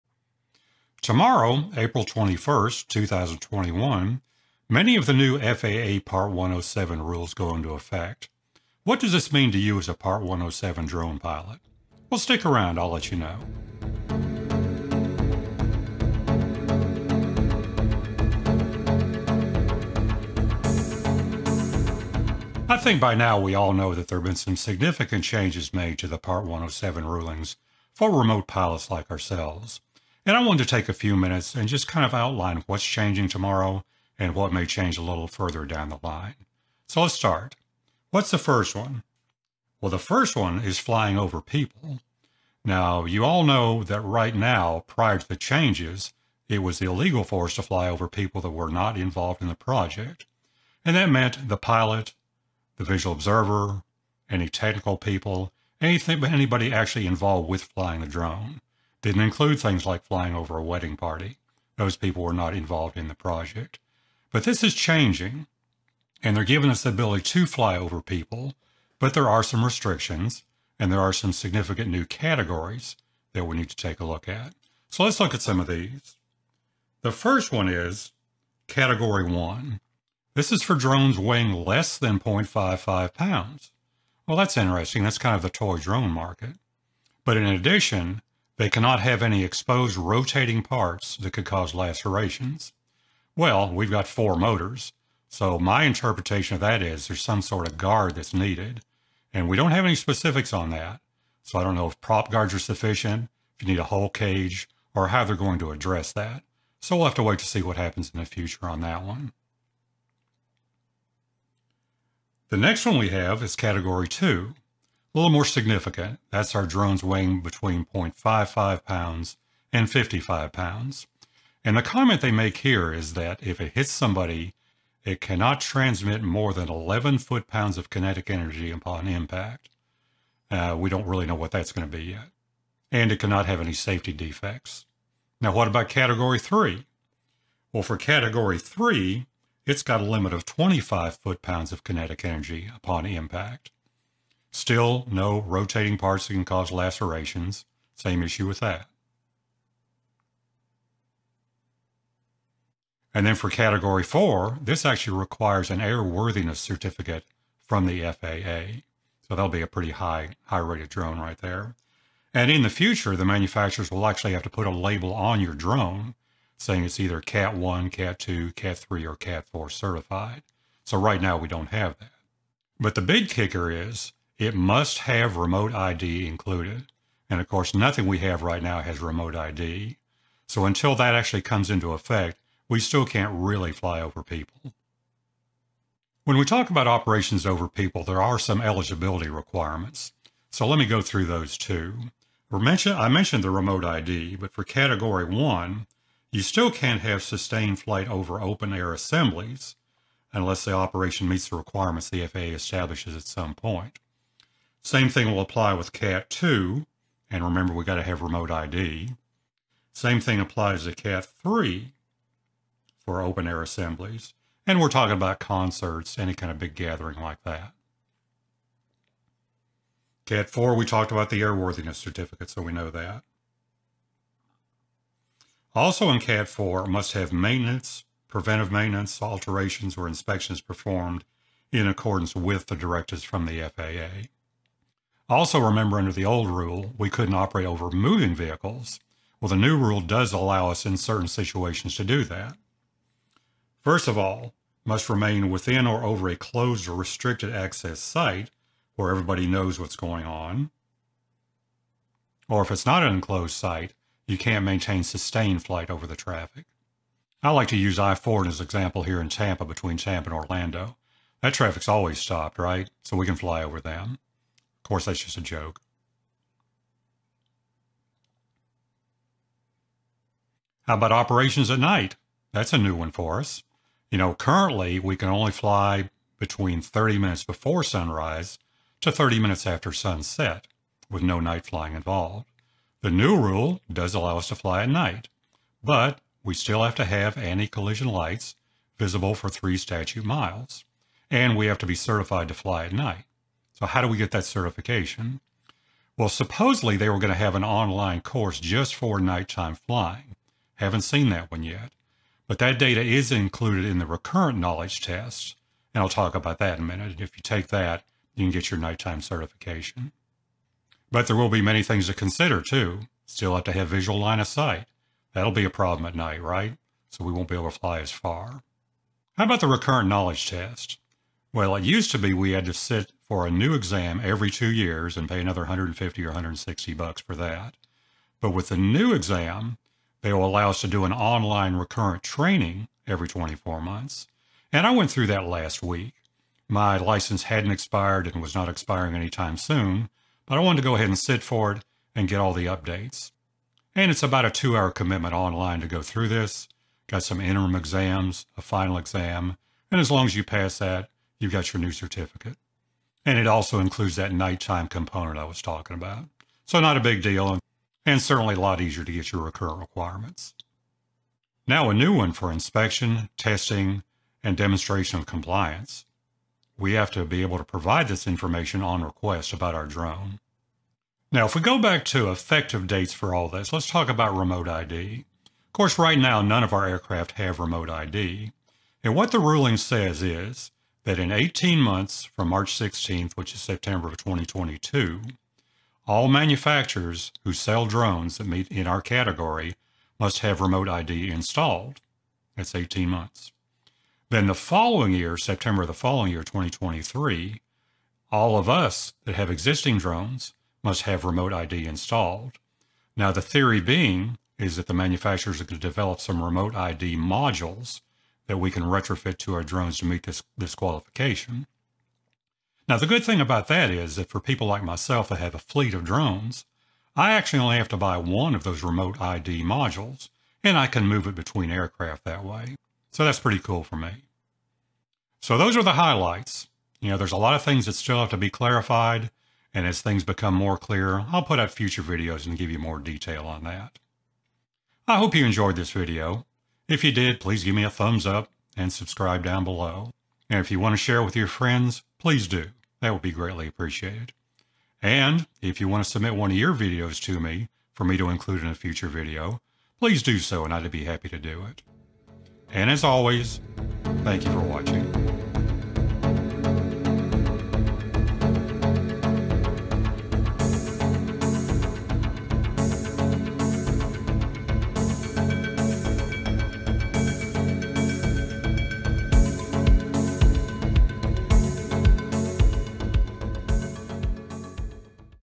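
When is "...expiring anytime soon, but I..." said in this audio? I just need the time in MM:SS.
05:38.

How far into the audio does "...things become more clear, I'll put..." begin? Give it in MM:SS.
07:10.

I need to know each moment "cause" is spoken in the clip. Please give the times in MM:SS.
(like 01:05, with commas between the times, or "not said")
01:31, 02:26.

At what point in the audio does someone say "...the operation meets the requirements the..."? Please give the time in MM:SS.
03:20.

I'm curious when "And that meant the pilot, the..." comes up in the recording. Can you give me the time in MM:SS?
00:50.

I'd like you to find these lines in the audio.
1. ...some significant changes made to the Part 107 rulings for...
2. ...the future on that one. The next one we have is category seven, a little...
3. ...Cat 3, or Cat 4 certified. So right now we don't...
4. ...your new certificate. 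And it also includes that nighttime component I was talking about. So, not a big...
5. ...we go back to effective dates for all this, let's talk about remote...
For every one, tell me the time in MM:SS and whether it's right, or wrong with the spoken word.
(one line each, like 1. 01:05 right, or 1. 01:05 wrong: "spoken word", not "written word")
1. 00:24 right
2. 01:48 wrong: "two", not "seven"
3. 02:48 right
4. 05:51 right
5. 06:11 right.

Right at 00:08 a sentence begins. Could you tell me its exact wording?
What does this mean to you as a Part 107 drone pilot?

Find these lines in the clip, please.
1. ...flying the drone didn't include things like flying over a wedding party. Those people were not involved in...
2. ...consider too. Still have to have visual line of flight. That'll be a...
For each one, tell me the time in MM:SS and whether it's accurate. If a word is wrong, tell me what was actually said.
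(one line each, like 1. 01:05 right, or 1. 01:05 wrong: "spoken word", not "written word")
1. 00:57 right
2. 05:12 wrong: "sight", not "flight".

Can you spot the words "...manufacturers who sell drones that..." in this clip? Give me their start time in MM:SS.
06:26.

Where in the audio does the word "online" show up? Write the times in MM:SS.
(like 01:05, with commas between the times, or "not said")
04:57, 05:31, 05:45.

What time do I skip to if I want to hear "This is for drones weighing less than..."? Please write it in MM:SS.
01:20.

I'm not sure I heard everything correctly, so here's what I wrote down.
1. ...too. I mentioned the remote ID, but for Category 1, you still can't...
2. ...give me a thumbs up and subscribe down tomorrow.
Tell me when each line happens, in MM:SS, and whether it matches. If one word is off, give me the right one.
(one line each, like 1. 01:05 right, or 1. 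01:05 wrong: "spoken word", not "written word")
1. 03:11 right
2. 07:17 wrong: "below", not "tomorrow".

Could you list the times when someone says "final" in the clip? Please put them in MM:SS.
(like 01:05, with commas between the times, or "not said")
05:48.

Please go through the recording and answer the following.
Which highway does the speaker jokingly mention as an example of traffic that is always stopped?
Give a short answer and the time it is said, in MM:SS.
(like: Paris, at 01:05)
I-4, at 04:17.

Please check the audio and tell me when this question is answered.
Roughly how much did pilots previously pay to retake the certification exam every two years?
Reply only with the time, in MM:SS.
05:25.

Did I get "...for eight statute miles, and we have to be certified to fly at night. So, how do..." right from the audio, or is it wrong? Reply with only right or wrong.
wrong.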